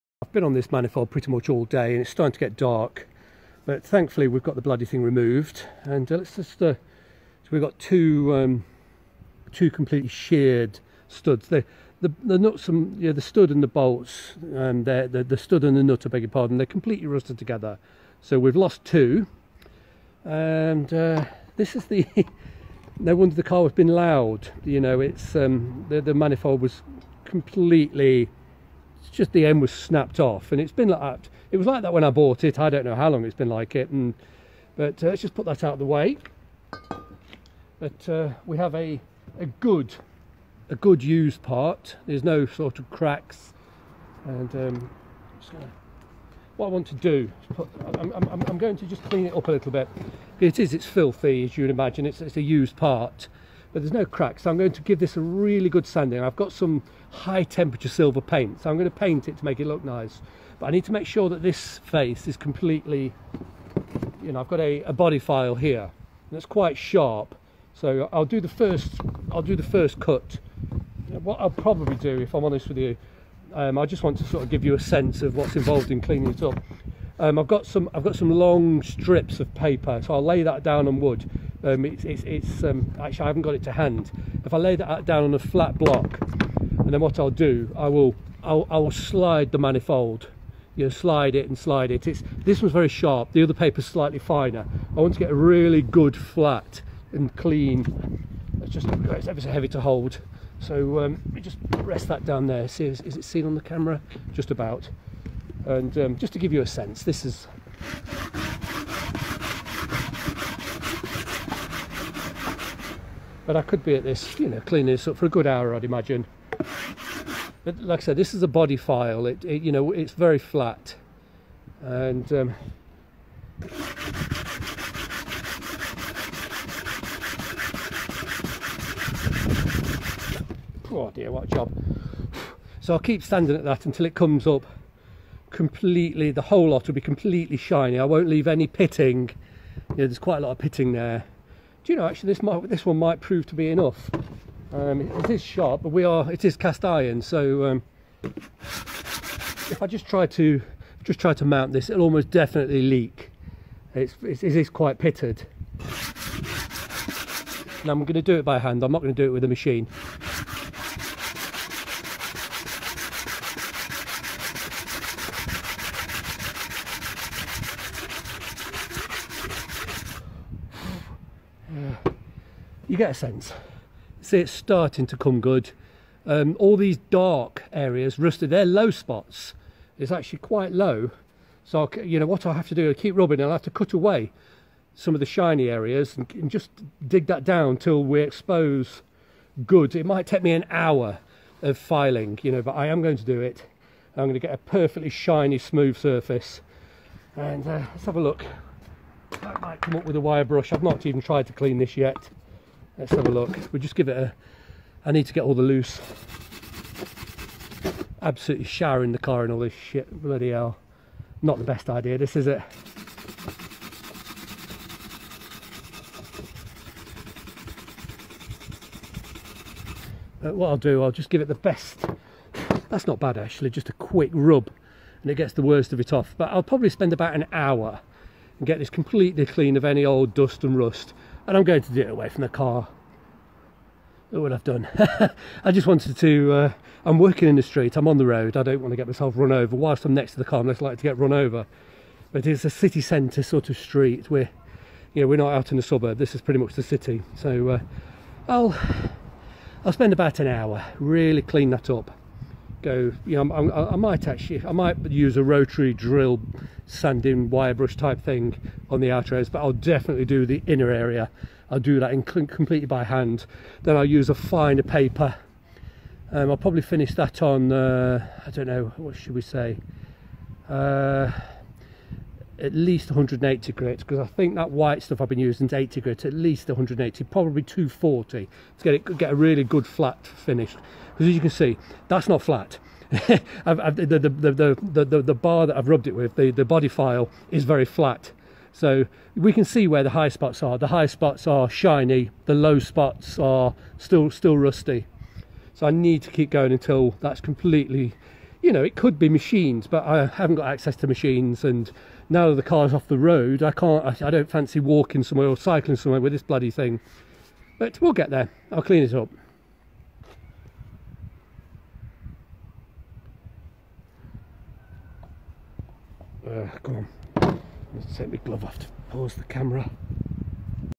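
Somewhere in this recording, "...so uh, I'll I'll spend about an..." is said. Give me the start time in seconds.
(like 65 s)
247 s.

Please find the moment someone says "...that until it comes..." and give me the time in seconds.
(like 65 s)
133 s.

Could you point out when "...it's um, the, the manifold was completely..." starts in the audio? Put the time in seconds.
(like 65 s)
24 s.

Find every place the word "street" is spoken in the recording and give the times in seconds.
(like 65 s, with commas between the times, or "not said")
237 s, 243 s.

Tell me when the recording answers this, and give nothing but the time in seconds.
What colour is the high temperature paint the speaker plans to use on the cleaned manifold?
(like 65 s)
57 s.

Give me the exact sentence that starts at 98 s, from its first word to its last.
It's just it's ever so heavy to hold.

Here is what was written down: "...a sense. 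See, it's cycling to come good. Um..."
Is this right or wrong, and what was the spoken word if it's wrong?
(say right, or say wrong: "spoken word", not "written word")
wrong: "starting", not "cycling".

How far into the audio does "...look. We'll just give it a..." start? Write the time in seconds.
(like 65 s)
203 s.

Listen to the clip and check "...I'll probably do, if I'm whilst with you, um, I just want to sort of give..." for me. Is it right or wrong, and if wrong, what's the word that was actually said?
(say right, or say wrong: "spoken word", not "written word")
wrong: "honest", not "whilst".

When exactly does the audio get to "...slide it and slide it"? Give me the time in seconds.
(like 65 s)
90 s.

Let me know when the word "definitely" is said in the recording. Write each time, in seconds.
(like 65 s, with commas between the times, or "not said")
152 s, 259 s.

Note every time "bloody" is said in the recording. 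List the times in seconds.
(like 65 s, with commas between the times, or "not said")
4 s, 210 s, 306 s.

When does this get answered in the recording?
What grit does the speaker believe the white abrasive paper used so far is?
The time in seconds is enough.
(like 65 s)
275 s.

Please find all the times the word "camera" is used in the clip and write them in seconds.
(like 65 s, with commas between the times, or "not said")
103 s, 319 s.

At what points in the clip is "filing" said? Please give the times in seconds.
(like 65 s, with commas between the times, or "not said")
191 s.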